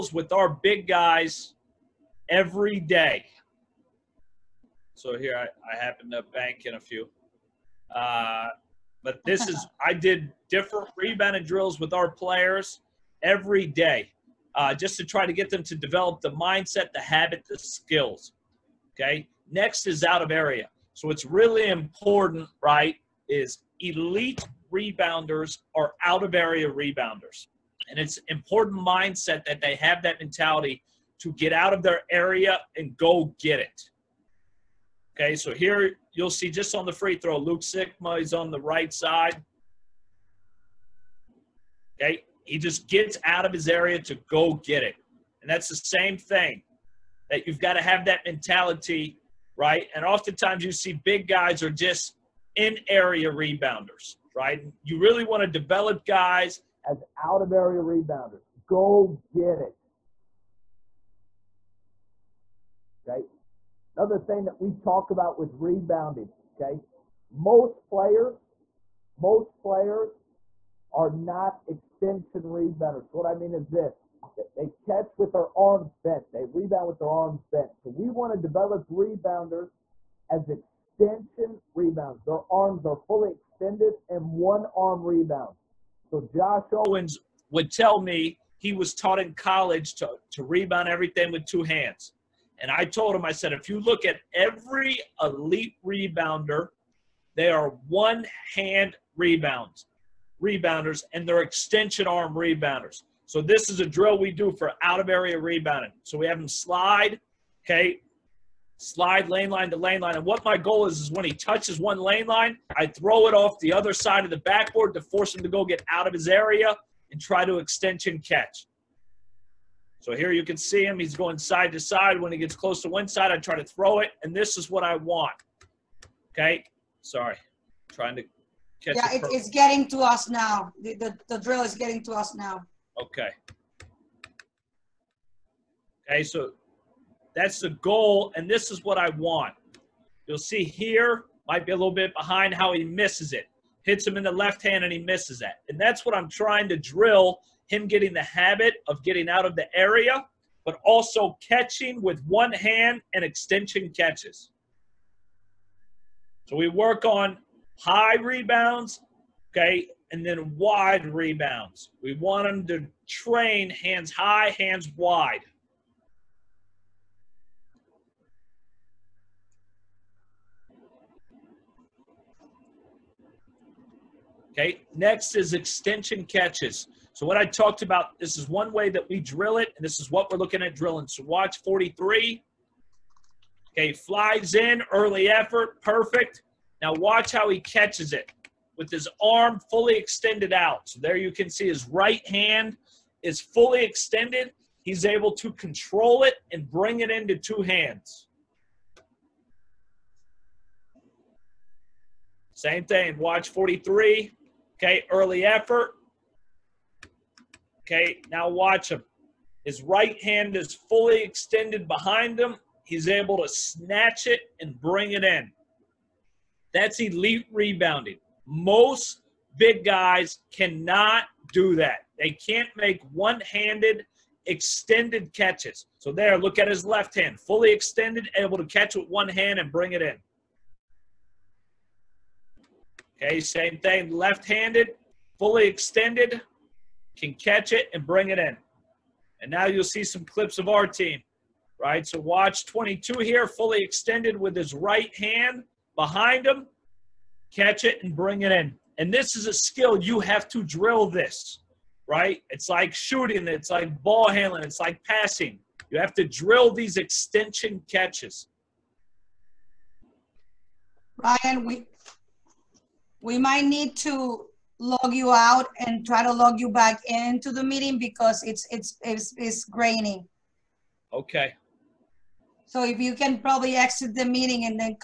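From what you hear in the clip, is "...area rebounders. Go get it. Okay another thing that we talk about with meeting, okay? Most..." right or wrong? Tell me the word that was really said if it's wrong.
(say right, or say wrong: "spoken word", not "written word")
wrong: "rebounding", not "meeting".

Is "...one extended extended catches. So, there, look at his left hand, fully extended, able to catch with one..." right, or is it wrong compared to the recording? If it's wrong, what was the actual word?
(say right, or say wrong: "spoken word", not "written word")
wrong: "handed", not "extended".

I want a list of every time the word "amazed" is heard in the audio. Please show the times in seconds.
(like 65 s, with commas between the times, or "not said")
not said.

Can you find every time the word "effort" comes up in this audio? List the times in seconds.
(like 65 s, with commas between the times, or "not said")
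185 s, 205 s.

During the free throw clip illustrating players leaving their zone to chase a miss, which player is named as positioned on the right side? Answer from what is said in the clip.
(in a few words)
Luke Sikma.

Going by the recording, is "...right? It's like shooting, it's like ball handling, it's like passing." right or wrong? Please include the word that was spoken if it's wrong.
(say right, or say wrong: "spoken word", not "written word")
right.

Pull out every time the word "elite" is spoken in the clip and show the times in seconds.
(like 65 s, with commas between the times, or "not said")
23 s, 95 s, 217 s.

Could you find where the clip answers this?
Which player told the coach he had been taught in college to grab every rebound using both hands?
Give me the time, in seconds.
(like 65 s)
86 s.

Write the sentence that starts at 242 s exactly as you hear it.
So watch 22 here, fully extended with his right hand behind him, catch it and bring it in.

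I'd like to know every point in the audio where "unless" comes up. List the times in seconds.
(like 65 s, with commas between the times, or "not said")
not said.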